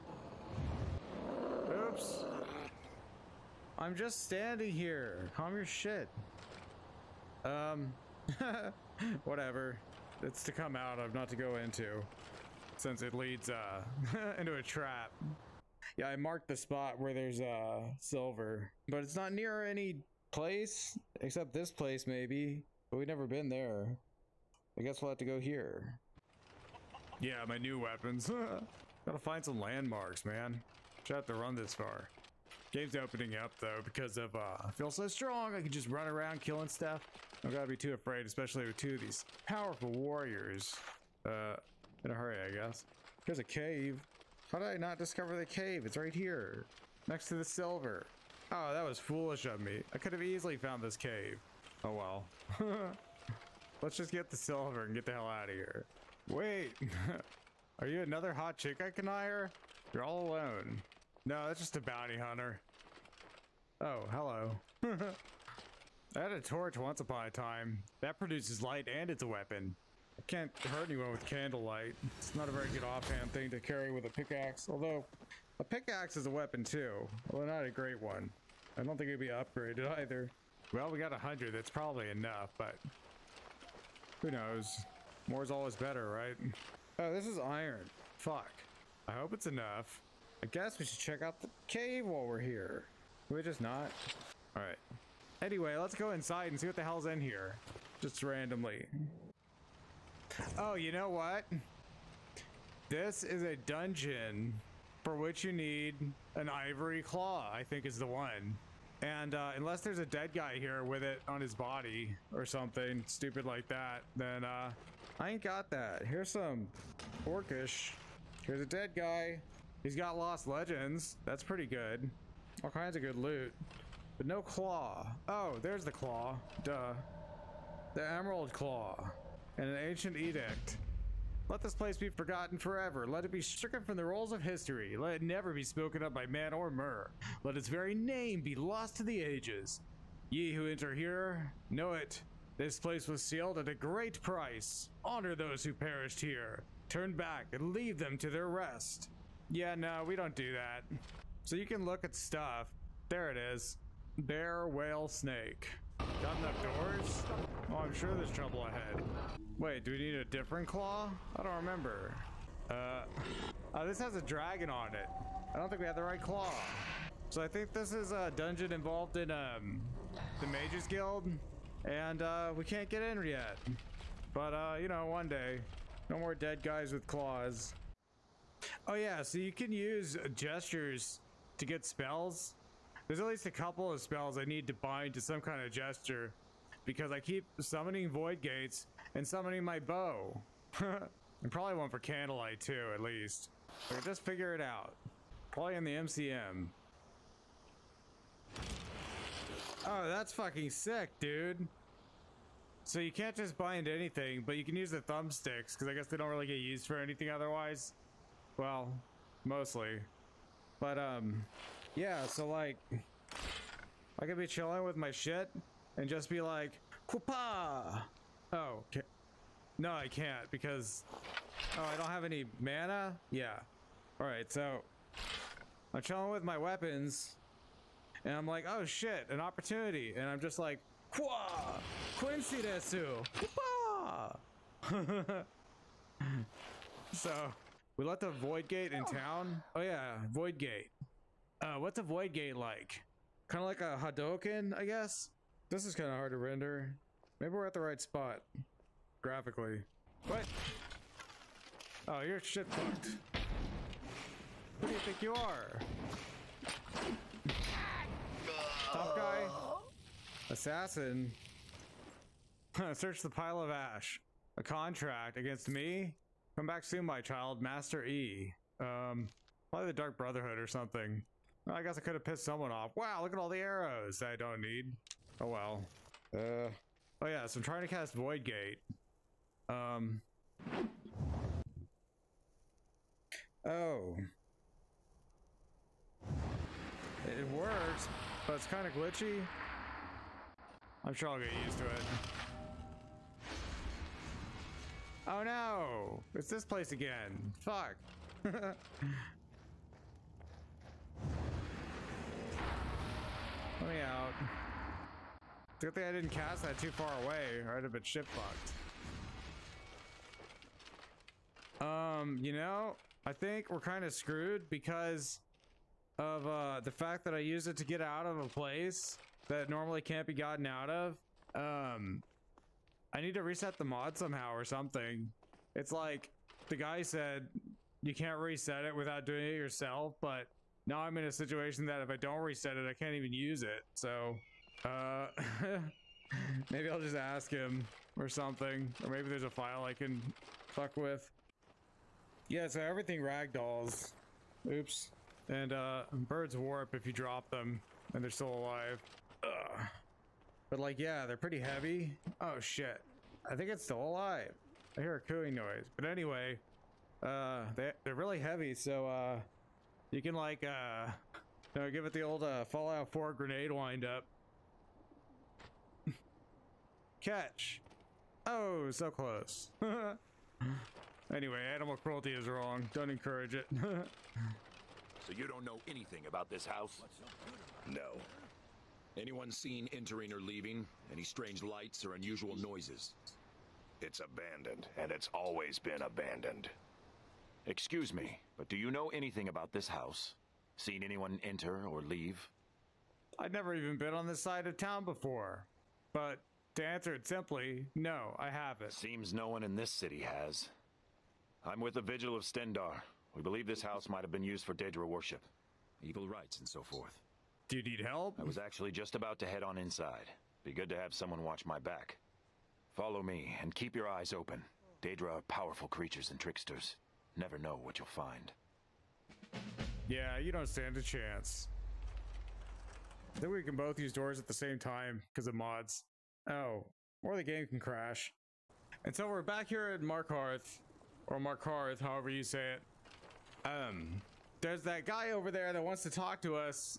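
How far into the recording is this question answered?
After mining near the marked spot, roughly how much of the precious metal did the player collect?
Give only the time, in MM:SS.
01:21.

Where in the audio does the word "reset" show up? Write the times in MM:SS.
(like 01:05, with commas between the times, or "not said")
05:23, 05:28, 05:32.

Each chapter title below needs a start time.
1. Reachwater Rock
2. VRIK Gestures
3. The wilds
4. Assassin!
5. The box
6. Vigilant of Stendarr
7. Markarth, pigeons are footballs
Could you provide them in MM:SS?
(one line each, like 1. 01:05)
1. 01:40
2. 03:17
3. 05:09
4. 04:10
5. 04:54
6. 06:15
7. 05:42.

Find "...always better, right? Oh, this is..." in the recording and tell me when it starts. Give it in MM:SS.
01:25.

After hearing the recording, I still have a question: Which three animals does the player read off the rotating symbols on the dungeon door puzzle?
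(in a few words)
Bear, whale, snake.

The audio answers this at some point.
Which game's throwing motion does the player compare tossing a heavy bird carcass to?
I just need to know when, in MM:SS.
06:02.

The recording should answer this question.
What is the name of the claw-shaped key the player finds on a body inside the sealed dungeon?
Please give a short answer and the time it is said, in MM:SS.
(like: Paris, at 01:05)
Emerald Claw, at 02:07.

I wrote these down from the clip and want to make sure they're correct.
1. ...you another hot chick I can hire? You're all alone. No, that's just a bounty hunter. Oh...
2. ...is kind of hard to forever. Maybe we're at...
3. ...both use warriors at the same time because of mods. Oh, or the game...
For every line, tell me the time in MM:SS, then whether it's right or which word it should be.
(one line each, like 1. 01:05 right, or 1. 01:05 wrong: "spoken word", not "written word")
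1. 00:57 right
2. 04:05 wrong: "render", not "forever"
3. 07:03 wrong: "doors", not "warriors".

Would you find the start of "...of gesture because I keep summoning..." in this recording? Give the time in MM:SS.
03:05.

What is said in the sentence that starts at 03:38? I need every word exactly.
Oh, no, I can't because, oh, I don't have any mana?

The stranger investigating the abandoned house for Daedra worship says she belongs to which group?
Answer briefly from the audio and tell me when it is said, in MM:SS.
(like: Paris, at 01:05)
Vigil of Stendarr, at 06:42.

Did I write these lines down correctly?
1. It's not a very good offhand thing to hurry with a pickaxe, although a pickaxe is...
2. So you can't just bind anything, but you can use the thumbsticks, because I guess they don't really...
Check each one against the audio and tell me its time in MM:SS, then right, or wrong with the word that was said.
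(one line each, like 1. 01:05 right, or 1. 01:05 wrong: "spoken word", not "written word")
1. 01:12 wrong: "carry", not "hurry"
2. 03:22 right.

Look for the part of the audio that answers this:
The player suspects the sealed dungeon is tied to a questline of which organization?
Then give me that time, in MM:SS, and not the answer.
02:50.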